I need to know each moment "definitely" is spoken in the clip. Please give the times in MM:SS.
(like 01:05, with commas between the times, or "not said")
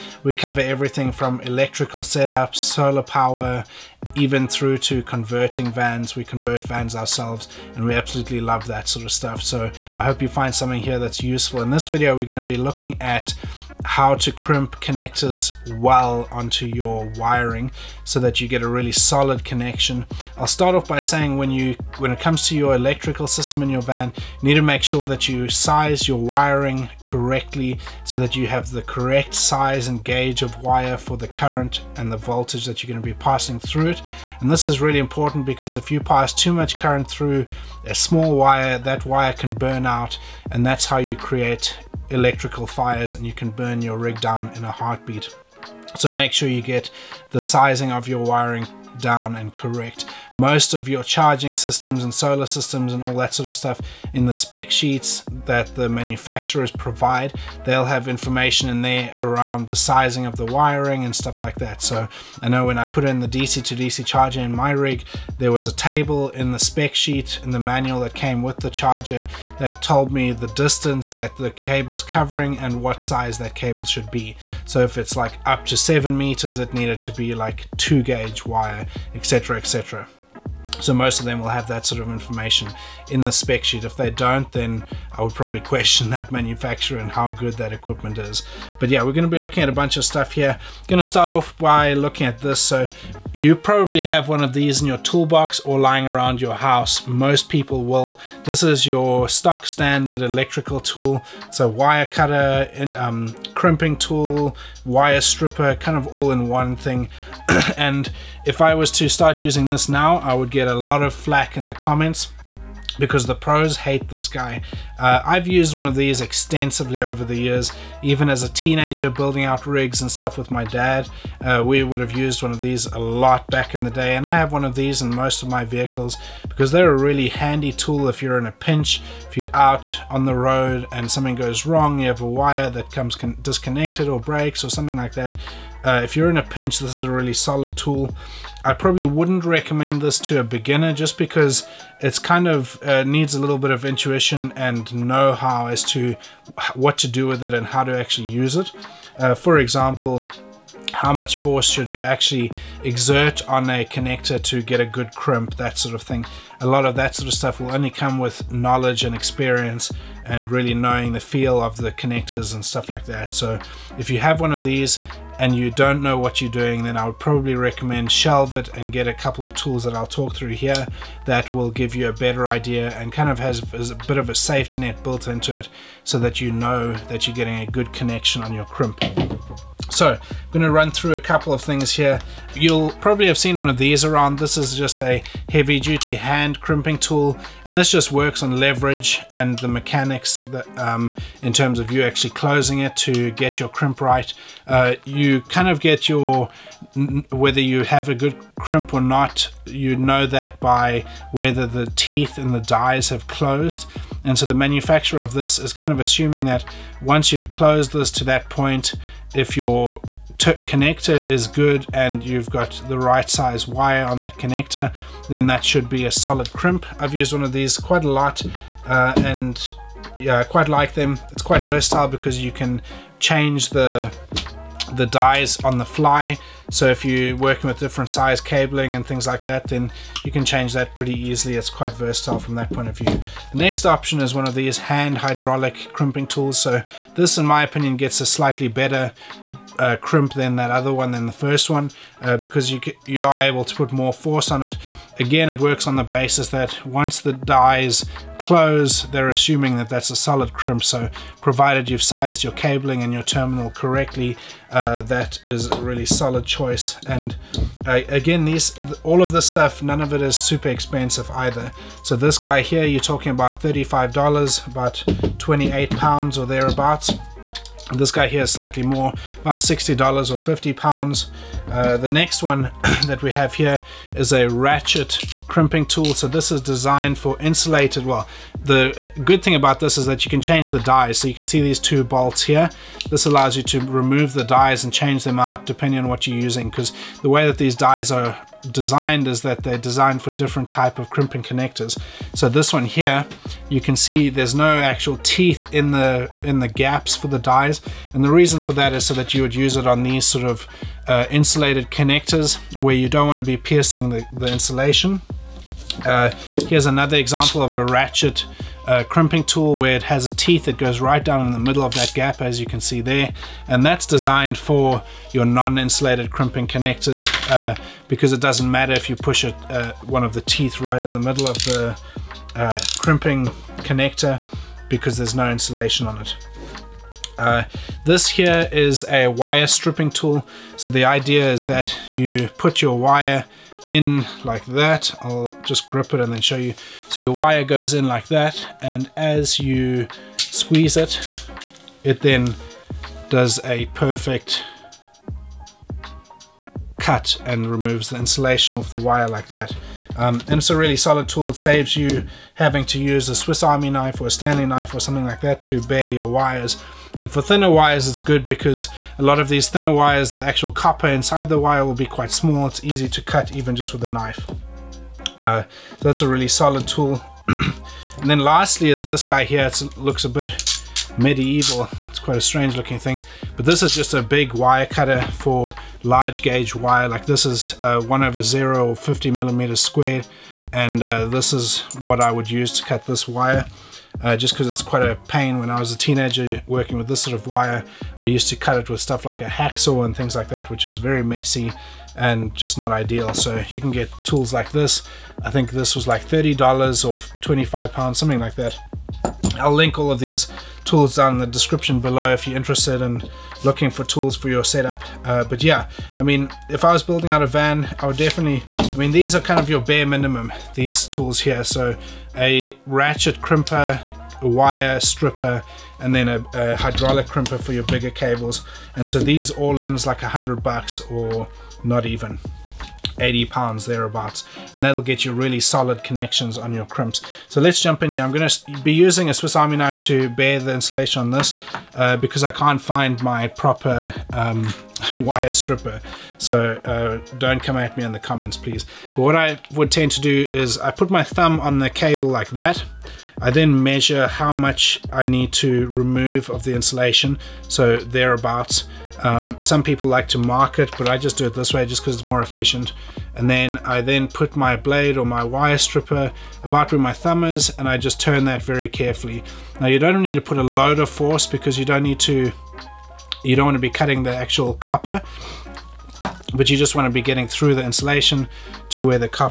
06:48.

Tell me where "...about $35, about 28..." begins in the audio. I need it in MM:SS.
04:23.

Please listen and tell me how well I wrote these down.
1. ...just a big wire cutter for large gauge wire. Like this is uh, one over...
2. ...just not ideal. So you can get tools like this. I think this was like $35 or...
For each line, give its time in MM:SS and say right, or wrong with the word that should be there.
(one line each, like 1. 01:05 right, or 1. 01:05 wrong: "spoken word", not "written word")
1. 06:13 right
2. 06:32 wrong: "30", not "35".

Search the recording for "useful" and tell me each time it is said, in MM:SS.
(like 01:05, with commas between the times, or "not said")
00:11.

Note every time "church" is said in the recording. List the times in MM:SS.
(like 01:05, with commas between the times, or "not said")
not said.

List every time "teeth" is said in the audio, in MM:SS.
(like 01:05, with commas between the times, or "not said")
03:21, 04:55, 05:10, 05:20.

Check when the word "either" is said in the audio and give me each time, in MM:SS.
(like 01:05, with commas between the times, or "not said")
04:21.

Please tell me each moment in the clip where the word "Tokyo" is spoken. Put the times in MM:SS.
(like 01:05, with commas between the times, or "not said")
not said.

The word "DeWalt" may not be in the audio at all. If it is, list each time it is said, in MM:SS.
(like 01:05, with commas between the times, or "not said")
not said.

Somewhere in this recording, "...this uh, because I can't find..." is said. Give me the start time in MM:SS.
07:11.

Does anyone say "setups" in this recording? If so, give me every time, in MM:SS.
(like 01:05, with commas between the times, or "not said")
00:02, 06:44.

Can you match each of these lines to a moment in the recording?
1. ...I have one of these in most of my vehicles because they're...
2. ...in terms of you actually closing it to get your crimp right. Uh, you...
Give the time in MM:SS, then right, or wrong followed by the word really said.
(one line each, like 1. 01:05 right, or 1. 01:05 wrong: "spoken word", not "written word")
1. 02:04 right
2. 03:11 right.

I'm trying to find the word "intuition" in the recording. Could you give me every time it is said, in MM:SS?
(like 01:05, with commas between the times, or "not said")
02:23.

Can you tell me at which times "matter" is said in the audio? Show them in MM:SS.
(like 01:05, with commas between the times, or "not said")
05:18.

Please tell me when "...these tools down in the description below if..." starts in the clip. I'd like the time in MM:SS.
06:40.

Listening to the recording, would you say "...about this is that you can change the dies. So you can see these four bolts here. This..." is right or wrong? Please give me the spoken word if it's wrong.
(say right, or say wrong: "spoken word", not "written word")
wrong: "two", not "four".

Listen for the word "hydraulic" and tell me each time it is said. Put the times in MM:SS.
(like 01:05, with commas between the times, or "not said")
03:55, 06:56.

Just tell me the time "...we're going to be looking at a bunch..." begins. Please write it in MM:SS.
01:29.